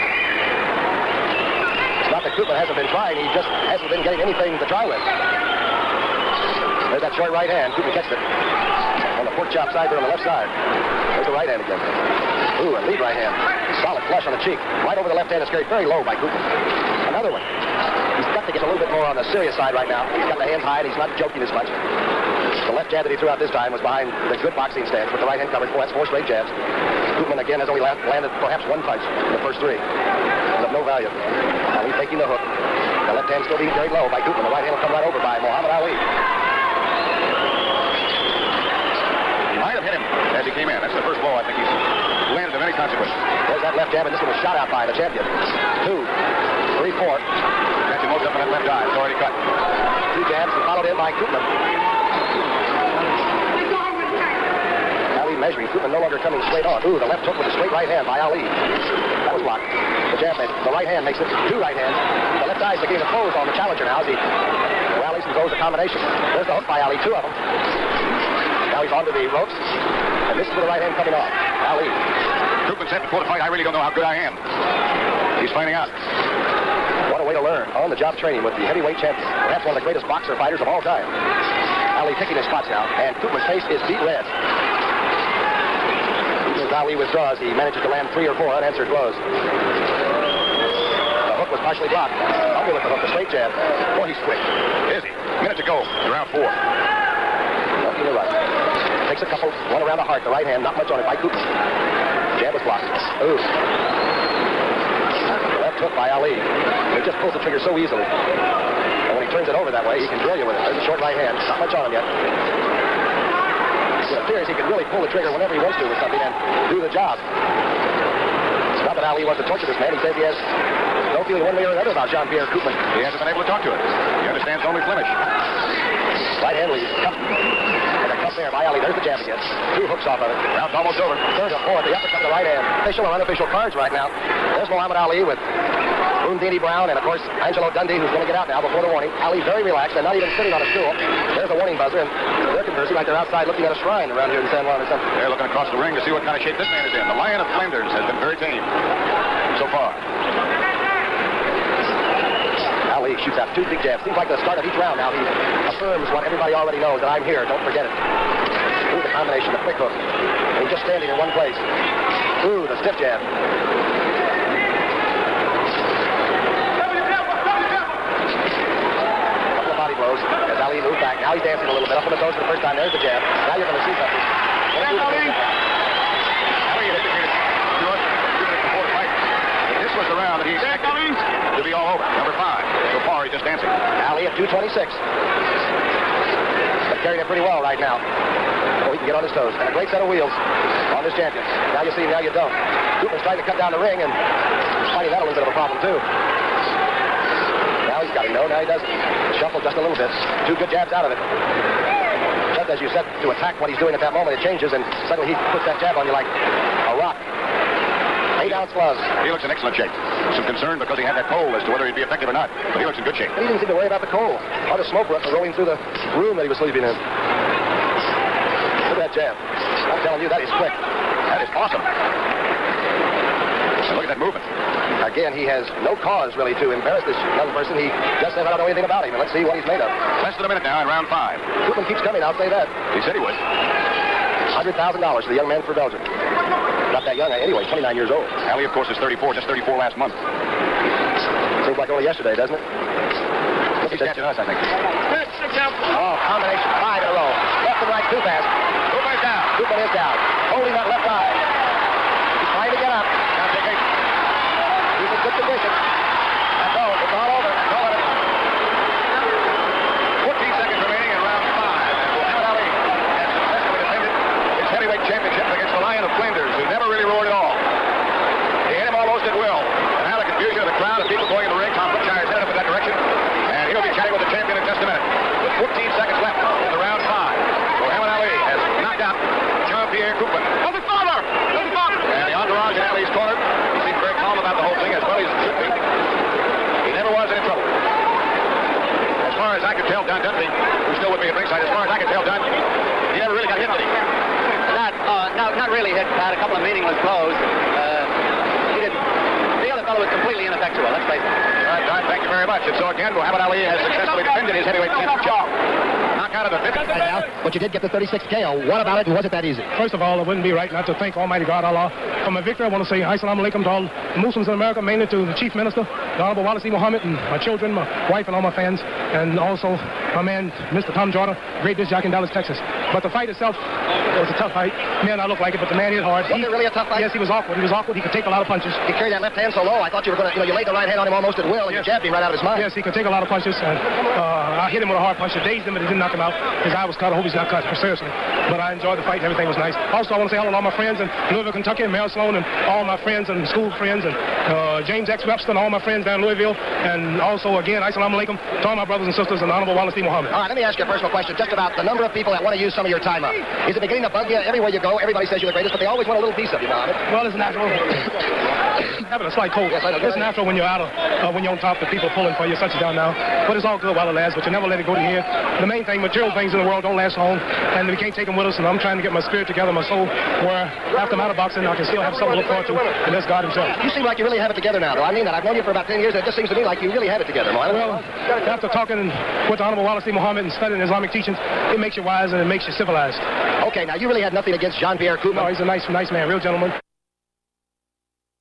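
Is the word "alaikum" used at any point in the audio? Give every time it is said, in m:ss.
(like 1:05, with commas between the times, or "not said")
5:13, 5:48.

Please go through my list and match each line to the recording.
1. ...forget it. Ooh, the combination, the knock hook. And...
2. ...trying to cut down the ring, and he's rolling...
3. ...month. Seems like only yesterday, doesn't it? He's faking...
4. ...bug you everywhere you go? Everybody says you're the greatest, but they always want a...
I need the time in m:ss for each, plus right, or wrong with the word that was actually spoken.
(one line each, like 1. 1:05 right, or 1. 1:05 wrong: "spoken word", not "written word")
1. 2:37 wrong: "quick", not "knock"
2. 3:13 wrong: "finding", not "rolling"
3. 3:59 wrong: "catching", not "faking"
4. 5:54 right.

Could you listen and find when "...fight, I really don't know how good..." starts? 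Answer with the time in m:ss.
1:13.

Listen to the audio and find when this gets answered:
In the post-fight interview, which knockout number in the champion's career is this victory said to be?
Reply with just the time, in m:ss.
5:07.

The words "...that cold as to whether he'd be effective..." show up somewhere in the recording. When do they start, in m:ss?
3:31.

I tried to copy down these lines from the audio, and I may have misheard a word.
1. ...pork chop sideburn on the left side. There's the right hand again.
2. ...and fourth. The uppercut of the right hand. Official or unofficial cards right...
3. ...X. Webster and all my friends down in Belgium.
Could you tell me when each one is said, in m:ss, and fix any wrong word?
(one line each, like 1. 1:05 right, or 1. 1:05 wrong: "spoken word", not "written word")
1. 0:09 right
2. 2:11 right
3. 5:45 wrong: "Louisville", not "Belgium".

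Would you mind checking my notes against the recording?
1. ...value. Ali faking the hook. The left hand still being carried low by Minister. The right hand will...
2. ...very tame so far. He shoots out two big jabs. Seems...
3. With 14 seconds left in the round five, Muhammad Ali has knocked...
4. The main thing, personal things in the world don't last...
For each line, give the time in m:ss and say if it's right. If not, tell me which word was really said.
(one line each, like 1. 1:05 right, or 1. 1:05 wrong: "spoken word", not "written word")
1. 0:30 wrong: "Coopman", not "Minister"
2. 2:28 right
3. 4:35 right
4. 6:05 wrong: "material", not "personal".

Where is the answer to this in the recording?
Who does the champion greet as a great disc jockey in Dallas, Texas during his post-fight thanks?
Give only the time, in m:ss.
5:20.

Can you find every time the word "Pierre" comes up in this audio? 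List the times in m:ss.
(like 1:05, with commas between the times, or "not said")
2:02, 4:39, 6:24.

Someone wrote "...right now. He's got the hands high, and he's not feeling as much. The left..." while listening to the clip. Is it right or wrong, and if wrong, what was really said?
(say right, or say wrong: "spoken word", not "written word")
wrong: "joking", not "feeling".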